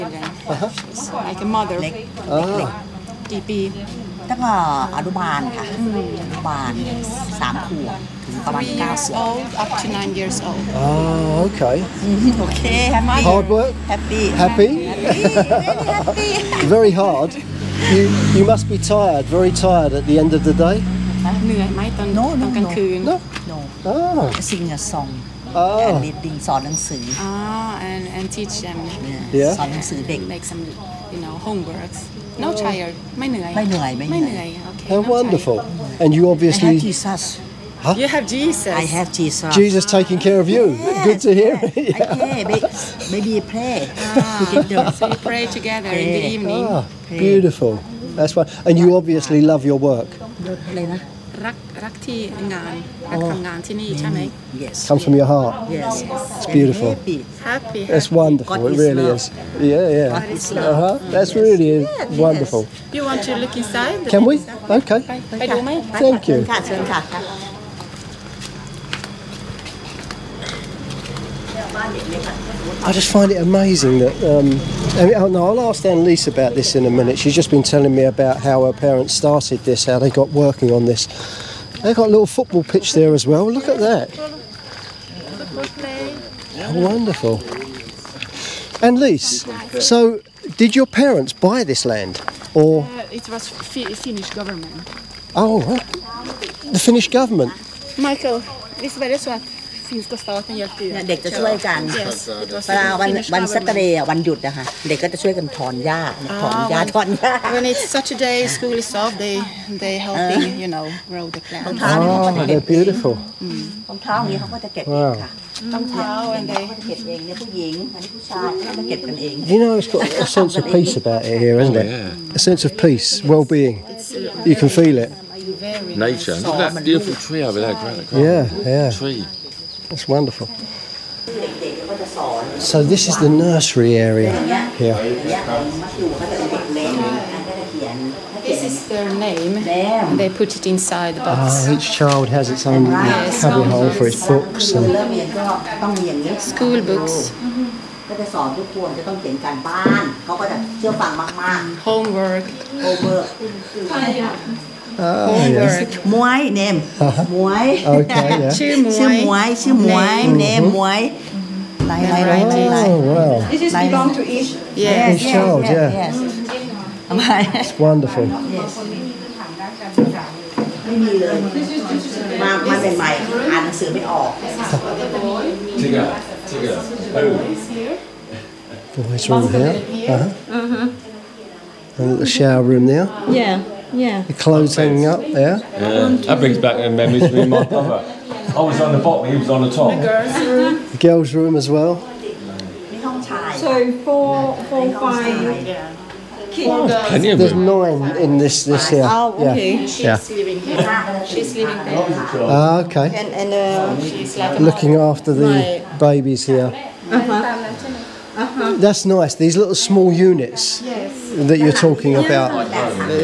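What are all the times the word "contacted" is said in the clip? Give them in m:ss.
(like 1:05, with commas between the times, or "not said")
not said.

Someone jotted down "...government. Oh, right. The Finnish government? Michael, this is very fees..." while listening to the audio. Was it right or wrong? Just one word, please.
right.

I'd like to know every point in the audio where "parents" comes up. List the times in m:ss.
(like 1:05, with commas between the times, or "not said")
1:18, 1:30.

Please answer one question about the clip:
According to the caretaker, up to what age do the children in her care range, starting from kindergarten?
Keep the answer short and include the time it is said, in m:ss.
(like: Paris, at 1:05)
9 years old, at 0:09.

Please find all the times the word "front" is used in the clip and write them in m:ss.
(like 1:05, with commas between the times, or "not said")
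not said.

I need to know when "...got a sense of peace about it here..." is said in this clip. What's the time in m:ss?
1:59.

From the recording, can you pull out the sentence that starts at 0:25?
and reading ส อ น ห น ั ง ส ื อ Ah, and and teach them Yeah.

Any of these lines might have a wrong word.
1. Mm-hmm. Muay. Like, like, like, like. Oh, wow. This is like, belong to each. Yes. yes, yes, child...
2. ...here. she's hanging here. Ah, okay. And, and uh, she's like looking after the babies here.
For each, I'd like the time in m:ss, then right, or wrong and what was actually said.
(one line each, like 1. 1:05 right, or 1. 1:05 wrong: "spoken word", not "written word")
1. 2:40 right
2. 3:20 wrong: "living", not "hanging".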